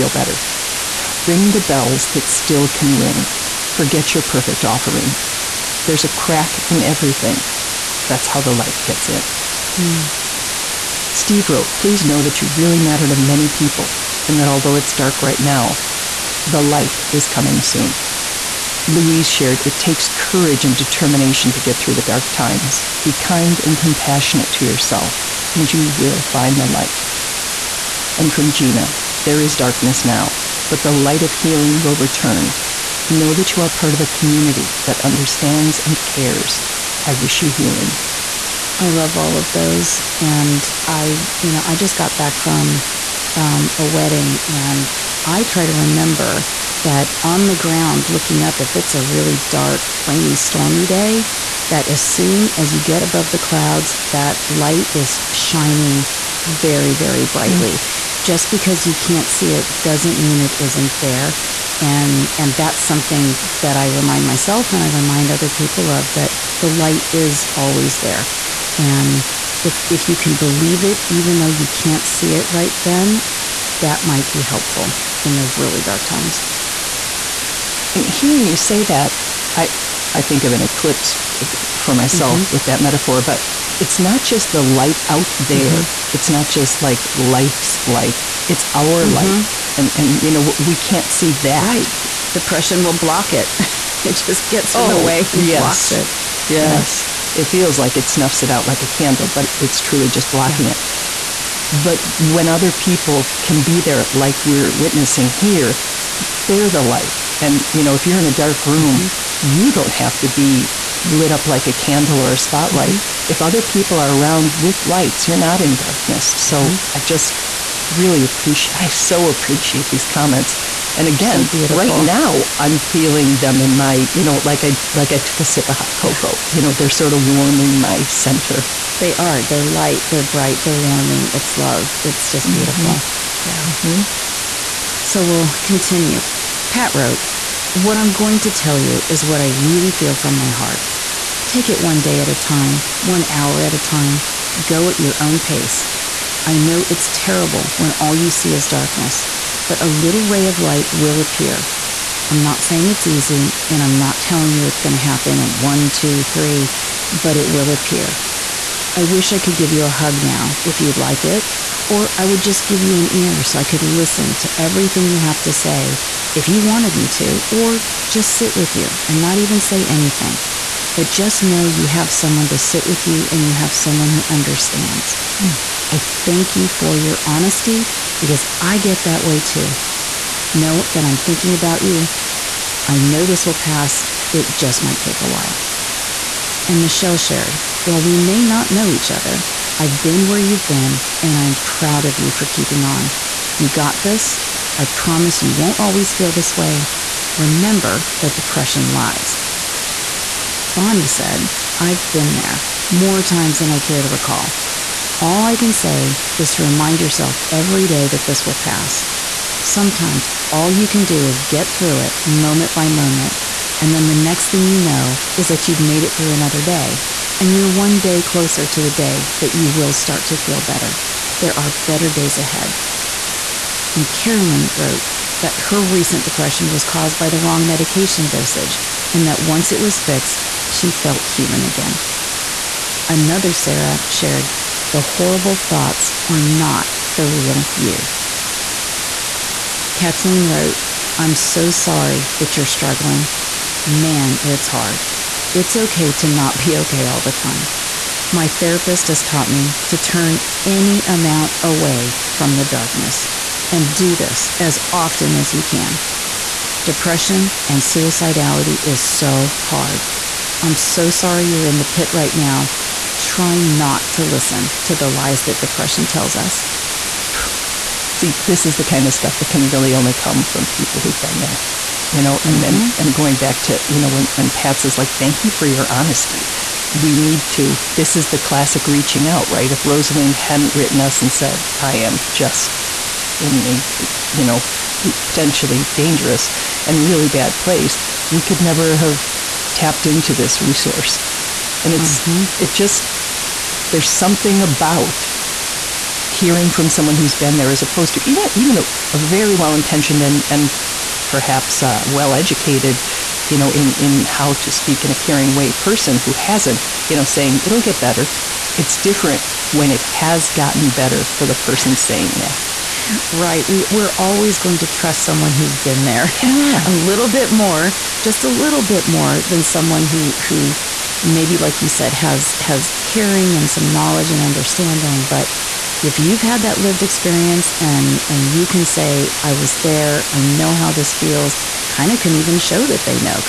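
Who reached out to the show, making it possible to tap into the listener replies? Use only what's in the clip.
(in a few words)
Rosaleen.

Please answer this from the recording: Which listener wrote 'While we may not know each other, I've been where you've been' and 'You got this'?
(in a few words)
Michelle.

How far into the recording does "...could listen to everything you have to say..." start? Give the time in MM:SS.
02:43.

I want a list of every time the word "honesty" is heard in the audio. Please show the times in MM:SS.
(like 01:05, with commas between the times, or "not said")
02:57, 04:35.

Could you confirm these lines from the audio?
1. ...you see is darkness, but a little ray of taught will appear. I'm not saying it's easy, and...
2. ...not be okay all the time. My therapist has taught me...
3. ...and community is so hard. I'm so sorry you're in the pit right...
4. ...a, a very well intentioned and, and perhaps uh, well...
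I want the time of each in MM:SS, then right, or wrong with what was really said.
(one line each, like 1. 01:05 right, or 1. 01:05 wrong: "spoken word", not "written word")
1. 02:28 wrong: "light", not "taught"
2. 04:06 right
3. 04:17 wrong: "suicidality", not "community"
4. 04:58 right.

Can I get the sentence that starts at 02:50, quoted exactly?
But just know you have someone to sit with you and you have someone who understands.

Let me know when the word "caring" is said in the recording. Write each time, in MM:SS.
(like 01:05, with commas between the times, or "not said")
05:05, 05:23.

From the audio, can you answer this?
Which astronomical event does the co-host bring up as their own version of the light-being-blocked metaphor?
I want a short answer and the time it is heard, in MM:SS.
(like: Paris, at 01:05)
an eclipse, at 01:20.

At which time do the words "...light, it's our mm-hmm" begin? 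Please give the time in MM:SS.
01:27.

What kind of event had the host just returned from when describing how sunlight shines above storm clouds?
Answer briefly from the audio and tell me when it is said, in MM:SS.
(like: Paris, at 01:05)
a wedding, at 00:43.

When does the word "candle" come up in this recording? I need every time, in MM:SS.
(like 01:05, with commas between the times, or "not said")
01:38, 01:51.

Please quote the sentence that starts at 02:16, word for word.
Pat wrote, what I'm going to tell you is what I really feel from my heart.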